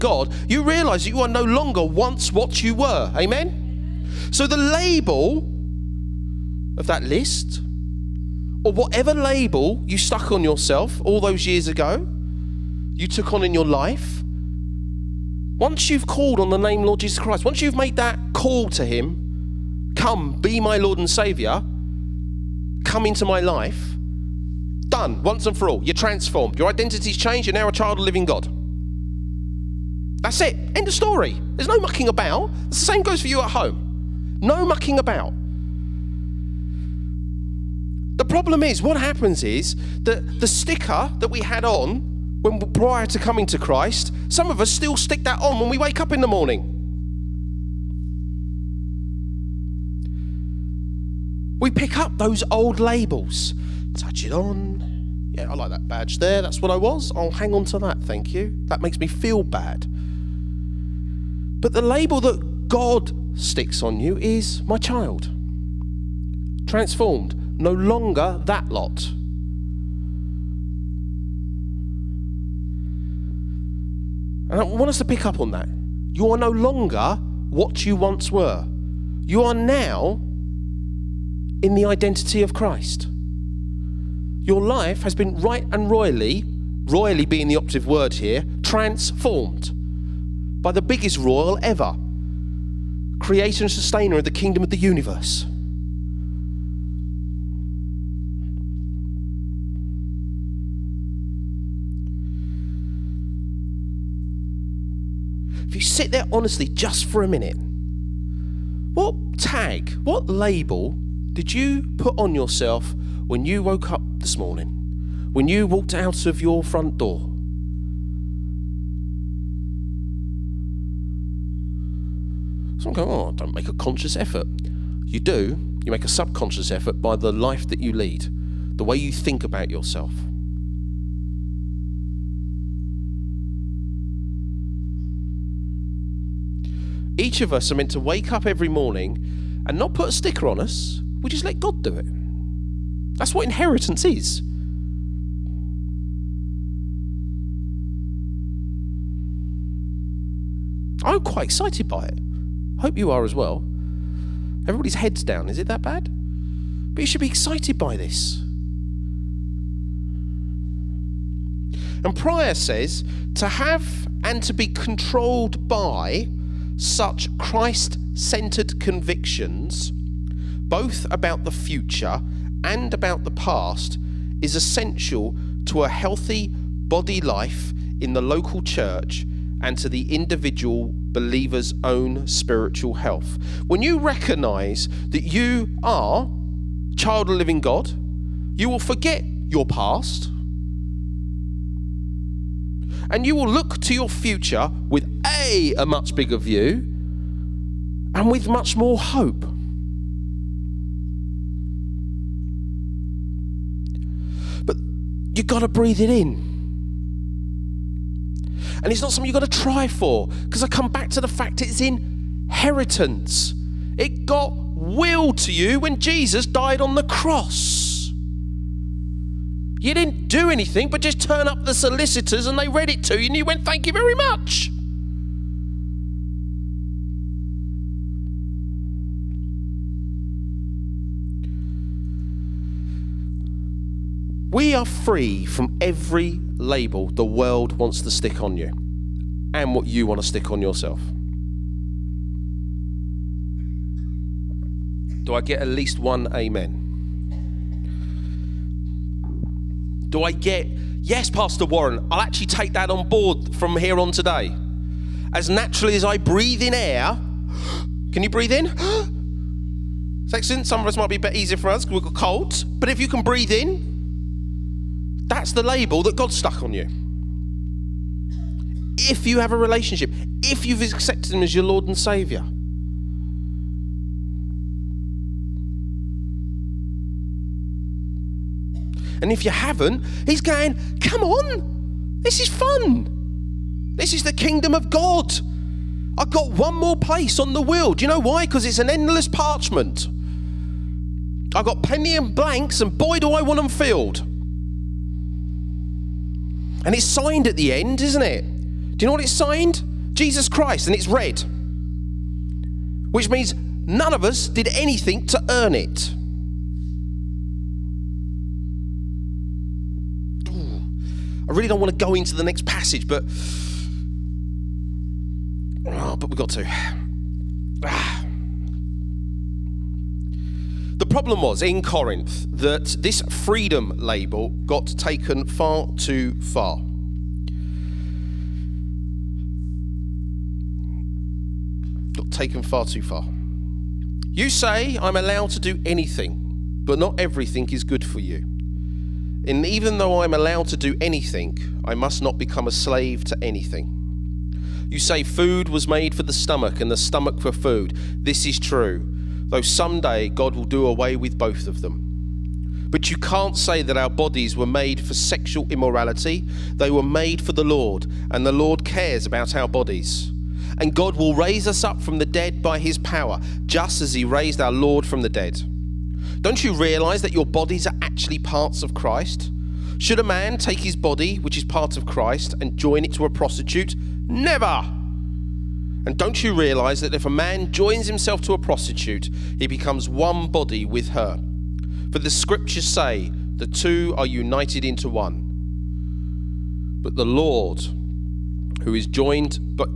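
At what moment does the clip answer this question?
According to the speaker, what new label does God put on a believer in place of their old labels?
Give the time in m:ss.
1:04.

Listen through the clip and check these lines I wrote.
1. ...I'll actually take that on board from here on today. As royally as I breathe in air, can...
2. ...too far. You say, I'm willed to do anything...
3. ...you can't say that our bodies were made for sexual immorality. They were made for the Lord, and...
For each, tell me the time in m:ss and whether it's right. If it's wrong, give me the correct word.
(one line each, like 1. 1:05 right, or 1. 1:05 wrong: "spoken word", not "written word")
1. 4:12 wrong: "naturally", not "royally"
2. 5:32 wrong: "allowed", not "willed"
3. 5:53 right.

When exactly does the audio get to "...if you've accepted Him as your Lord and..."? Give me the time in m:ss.
4:30.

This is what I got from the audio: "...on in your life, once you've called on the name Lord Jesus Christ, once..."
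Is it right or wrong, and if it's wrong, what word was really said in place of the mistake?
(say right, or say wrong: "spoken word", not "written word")
right.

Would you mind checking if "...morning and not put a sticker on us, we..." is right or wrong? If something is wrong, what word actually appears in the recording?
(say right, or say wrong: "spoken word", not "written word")
right.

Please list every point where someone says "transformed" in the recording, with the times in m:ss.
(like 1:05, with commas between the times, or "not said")
0:25, 1:06, 1:28.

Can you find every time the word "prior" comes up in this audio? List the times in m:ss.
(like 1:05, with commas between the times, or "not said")
0:42, 2:42.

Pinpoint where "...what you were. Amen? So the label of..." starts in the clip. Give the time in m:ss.
0:02.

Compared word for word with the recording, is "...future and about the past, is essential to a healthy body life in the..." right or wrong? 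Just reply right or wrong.
right.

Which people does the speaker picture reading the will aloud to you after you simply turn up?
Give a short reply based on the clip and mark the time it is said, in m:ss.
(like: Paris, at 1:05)
The solicitors, at 3:41.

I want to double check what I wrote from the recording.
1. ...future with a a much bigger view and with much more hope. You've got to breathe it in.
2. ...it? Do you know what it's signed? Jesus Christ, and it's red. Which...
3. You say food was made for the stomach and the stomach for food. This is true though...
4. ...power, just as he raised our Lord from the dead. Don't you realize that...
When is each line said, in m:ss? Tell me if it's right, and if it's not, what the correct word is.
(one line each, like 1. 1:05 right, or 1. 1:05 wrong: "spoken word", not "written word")
1. 3:14 right
2. 4:58 right
3. 5:44 right
4. 6:02 right.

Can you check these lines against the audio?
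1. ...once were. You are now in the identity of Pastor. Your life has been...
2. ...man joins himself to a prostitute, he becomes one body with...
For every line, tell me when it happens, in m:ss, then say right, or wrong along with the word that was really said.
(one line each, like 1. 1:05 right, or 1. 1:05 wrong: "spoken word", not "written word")
1. 1:17 wrong: "Christ", not "Pastor"
2. 6:17 right.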